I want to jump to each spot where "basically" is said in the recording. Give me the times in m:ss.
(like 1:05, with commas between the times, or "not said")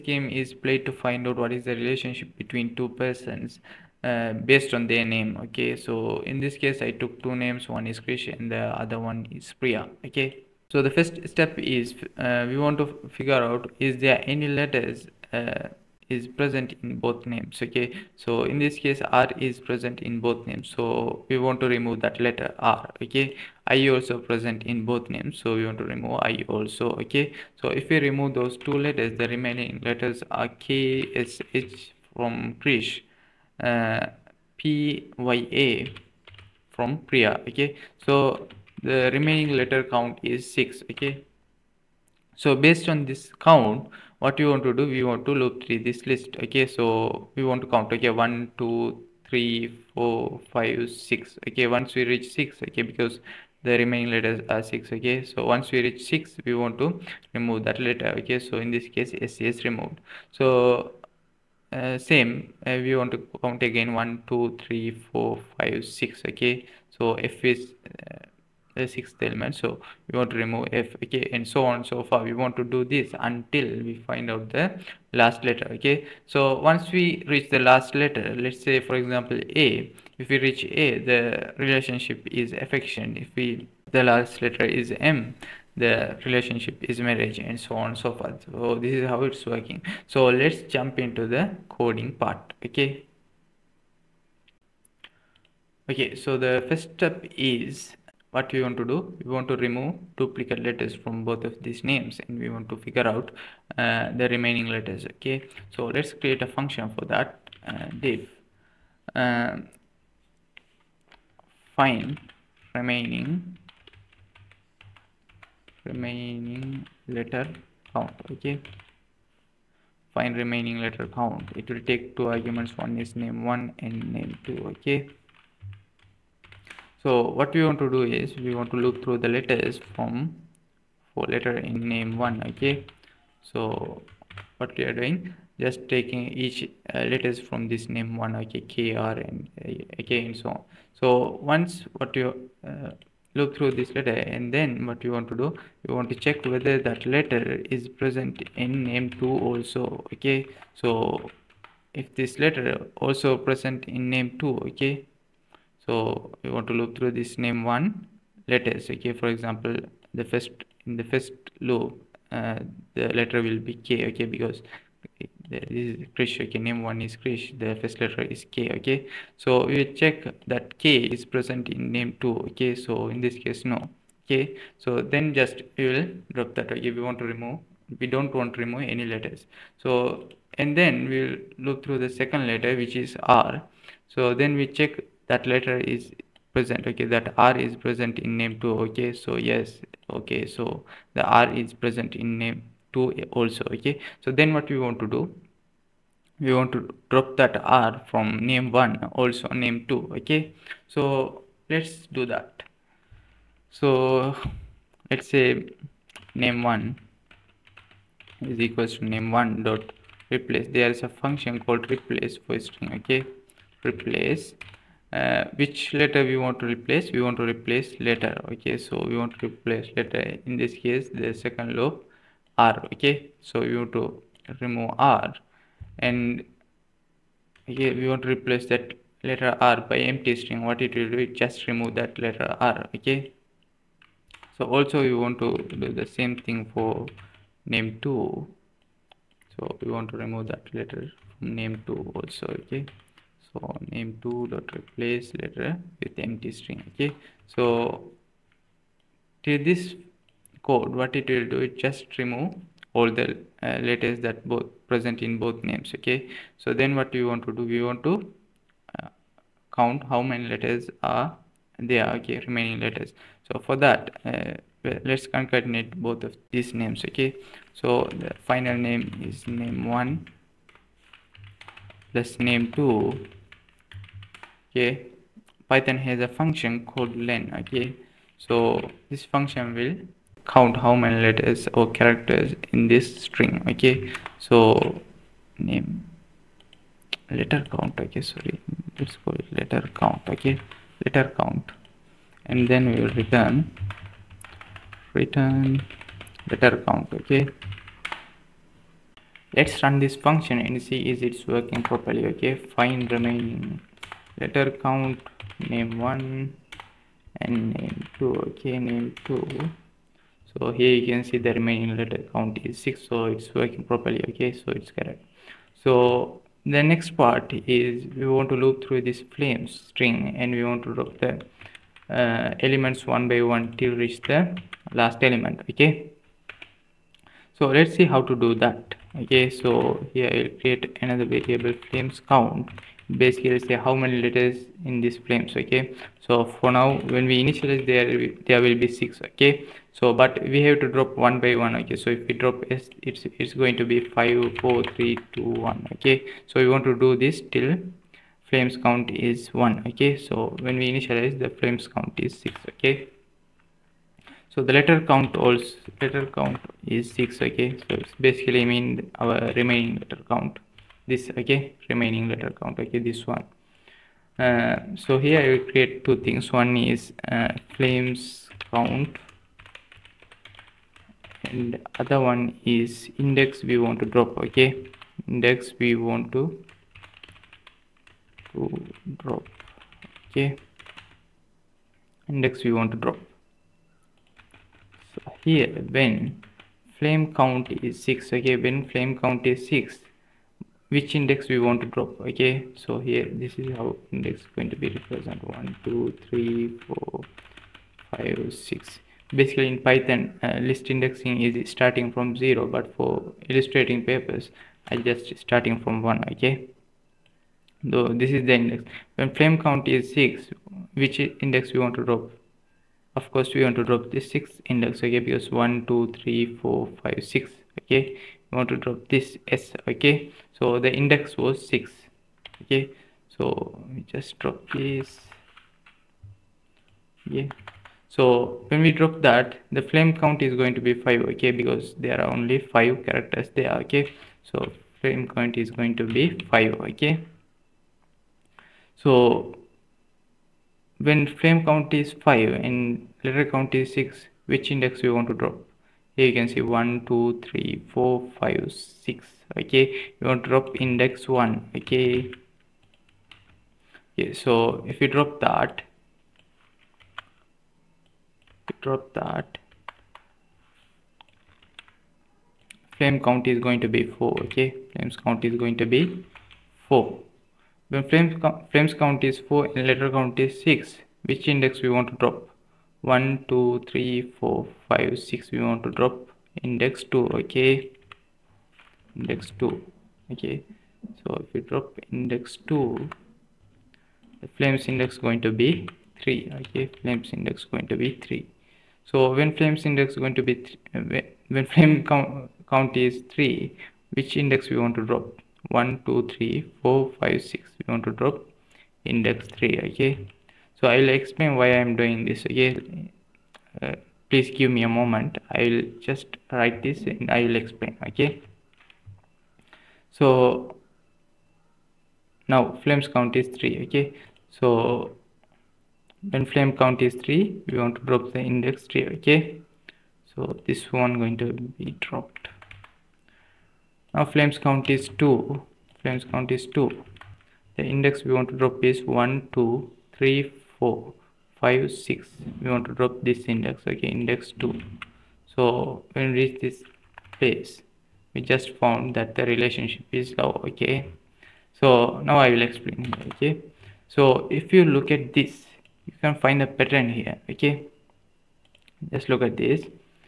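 5:33, 5:58, 6:39.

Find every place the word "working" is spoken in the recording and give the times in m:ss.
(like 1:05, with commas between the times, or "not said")
1:29, 5:01, 5:13.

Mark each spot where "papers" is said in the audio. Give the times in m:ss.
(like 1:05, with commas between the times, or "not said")
6:44.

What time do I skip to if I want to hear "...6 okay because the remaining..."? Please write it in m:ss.
0:52.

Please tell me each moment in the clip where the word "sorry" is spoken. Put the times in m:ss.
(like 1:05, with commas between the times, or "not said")
4:48.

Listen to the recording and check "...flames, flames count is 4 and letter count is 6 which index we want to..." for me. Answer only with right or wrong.
right.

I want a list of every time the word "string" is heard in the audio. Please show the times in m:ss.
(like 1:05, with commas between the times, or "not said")
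3:32, 3:50, 4:06, 4:43, 5:19.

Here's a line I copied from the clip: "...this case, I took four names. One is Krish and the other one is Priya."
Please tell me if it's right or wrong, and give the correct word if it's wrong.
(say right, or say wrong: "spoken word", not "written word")
wrong: "two", not "four".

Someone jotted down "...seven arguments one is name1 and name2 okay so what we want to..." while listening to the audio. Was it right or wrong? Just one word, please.
wrong.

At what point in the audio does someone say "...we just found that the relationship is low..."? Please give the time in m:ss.
8:58.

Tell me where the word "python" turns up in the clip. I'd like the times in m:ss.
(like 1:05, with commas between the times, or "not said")
4:35, 6:39.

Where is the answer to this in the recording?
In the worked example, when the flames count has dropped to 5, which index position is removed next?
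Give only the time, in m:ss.
7:30.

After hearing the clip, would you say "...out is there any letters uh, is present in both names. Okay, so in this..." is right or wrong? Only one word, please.
right.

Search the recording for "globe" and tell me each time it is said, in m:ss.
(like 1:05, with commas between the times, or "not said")
not said.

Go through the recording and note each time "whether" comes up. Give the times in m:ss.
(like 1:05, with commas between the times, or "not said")
2:26.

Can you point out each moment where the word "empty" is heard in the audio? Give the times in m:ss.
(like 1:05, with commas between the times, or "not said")
3:49, 4:06.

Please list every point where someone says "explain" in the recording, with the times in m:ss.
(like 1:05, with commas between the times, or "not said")
8:21, 8:27, 9:02.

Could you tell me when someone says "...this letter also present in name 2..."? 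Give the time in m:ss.
2:32.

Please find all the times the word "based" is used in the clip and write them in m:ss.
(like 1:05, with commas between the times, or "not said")
0:04, 0:42.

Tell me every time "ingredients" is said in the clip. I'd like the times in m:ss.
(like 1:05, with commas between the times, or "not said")
not said.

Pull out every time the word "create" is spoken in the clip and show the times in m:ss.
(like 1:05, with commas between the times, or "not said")
1:46, 5:30, 6:05.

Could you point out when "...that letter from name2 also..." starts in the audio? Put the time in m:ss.
4:00.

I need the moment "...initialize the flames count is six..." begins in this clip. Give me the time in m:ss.
5:50.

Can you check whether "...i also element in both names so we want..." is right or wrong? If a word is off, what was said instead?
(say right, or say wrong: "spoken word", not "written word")
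wrong: "present", not "element".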